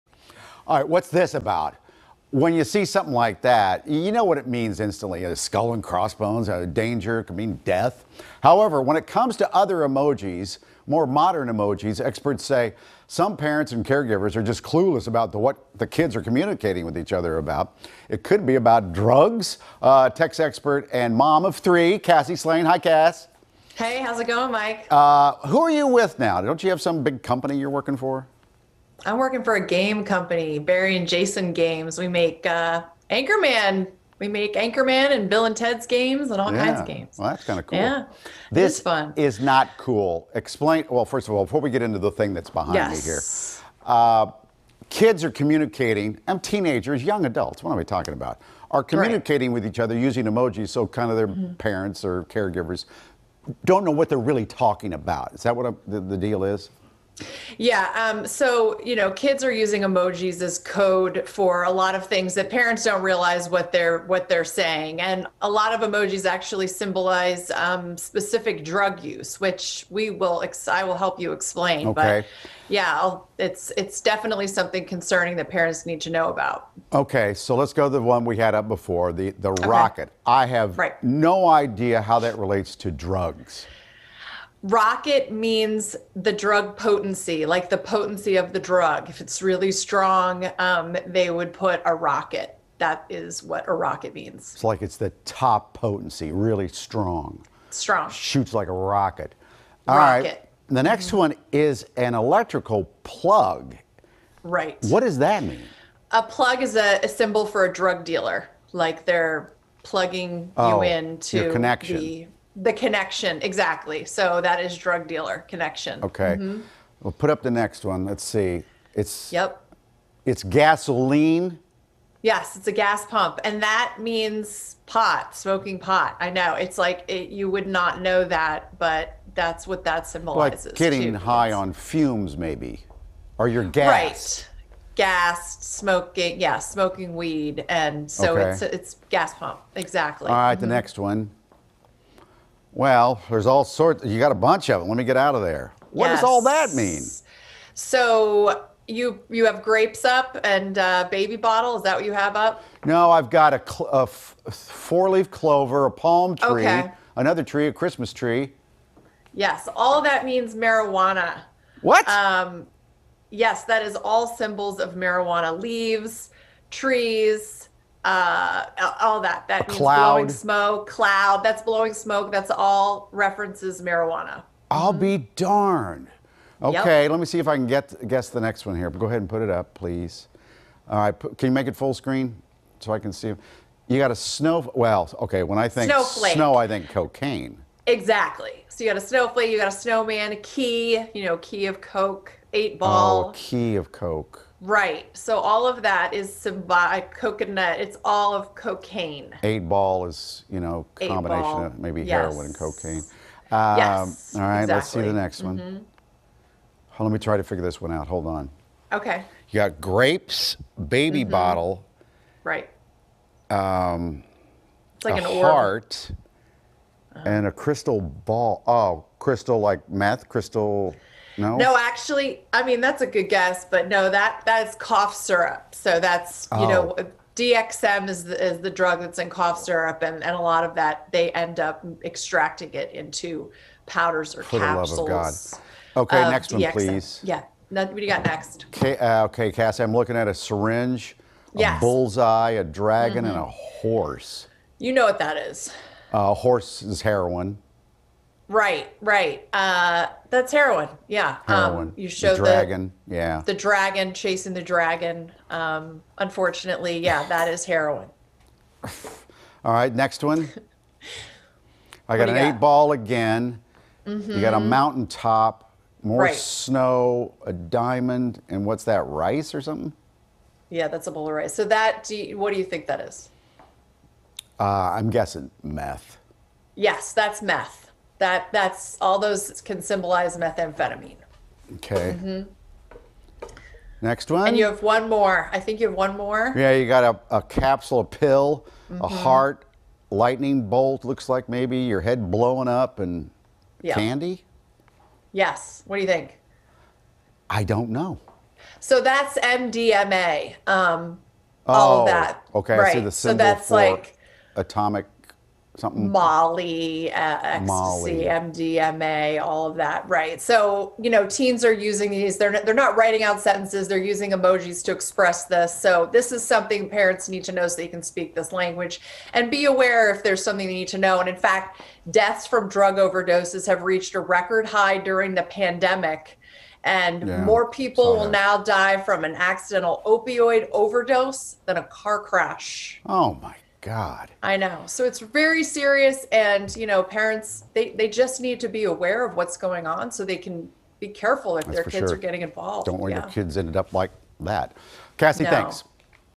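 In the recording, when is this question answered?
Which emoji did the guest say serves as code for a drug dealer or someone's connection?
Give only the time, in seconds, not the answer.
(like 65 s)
102 s.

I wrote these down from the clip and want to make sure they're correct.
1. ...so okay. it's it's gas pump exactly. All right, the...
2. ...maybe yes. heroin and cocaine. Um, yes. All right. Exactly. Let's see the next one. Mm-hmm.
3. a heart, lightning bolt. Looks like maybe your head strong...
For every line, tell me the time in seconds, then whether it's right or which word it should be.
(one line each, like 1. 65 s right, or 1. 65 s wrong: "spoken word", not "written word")
1. 138 s right
2. 201 s right
3. 289 s wrong: "blowing", not "strong".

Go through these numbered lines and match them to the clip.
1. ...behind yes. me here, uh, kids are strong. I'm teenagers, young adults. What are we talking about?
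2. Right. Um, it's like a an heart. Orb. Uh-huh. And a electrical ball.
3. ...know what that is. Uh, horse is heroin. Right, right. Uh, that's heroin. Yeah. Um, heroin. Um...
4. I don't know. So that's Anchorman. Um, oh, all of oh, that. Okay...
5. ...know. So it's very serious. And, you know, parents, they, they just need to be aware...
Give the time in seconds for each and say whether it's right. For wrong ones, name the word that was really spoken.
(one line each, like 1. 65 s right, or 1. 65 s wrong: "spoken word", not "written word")
1. 42 s wrong: "communicating", not "strong"
2. 212 s wrong: "crystal", not "electrical"
3. 244 s right
4. 297 s wrong: "MDMA", not "Anchorman"
5. 334 s right.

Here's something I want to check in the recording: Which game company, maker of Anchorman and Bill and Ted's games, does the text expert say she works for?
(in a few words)
Barry and Jason Games.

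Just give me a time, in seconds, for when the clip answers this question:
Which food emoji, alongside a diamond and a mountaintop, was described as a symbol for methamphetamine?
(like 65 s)
271 s.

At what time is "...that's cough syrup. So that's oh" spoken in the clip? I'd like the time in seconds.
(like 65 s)
224 s.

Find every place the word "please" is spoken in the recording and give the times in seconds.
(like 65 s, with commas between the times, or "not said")
179 s, 236 s.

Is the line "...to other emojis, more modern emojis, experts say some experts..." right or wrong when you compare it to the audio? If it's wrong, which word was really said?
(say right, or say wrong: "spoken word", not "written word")
wrong: "parents", not "experts".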